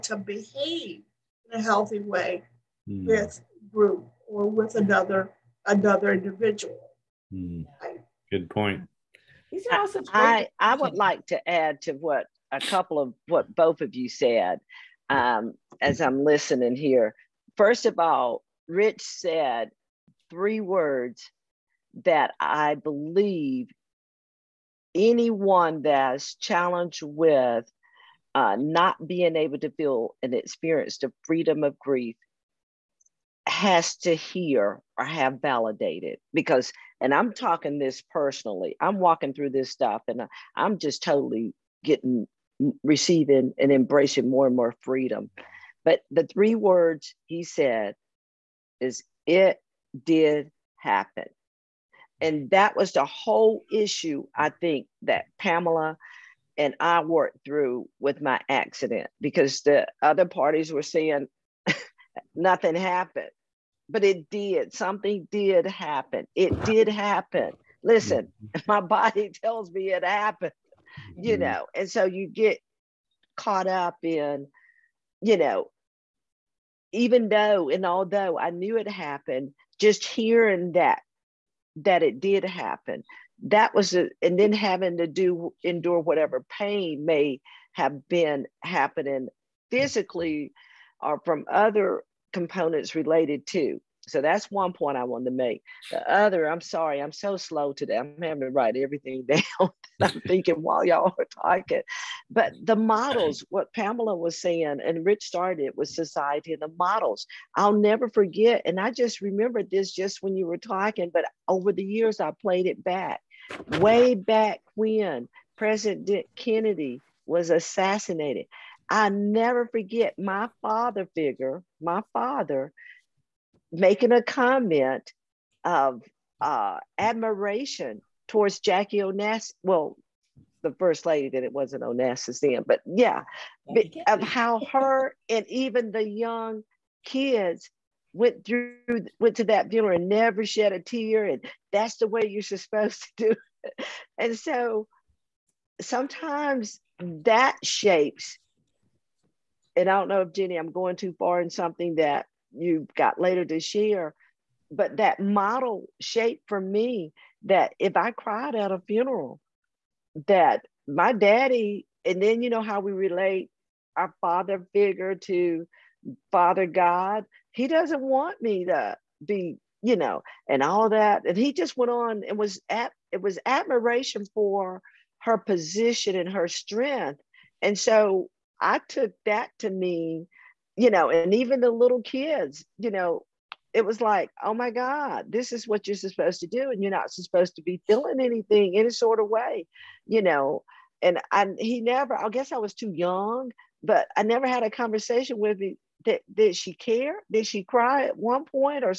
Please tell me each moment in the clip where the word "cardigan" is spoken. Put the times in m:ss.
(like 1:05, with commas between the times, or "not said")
not said.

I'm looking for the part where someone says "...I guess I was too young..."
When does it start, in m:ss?
3:12.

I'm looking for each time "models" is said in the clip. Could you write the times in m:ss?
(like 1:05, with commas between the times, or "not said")
1:42, 1:46, 2:35.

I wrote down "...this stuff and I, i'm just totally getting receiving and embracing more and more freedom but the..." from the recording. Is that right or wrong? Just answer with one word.
right.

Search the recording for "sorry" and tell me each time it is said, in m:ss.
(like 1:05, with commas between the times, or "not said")
1:36.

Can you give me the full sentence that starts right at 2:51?
And he just went on and was at it was admiration for her position and her strength.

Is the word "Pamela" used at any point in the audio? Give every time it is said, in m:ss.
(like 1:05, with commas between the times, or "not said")
0:55, 1:43.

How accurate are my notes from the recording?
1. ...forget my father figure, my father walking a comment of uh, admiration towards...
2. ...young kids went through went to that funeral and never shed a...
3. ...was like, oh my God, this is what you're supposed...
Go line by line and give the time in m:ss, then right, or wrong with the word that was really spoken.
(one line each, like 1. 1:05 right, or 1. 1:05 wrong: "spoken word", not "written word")
1. 1:59 wrong: "making", not "walking"
2. 2:16 right
3. 3:03 right.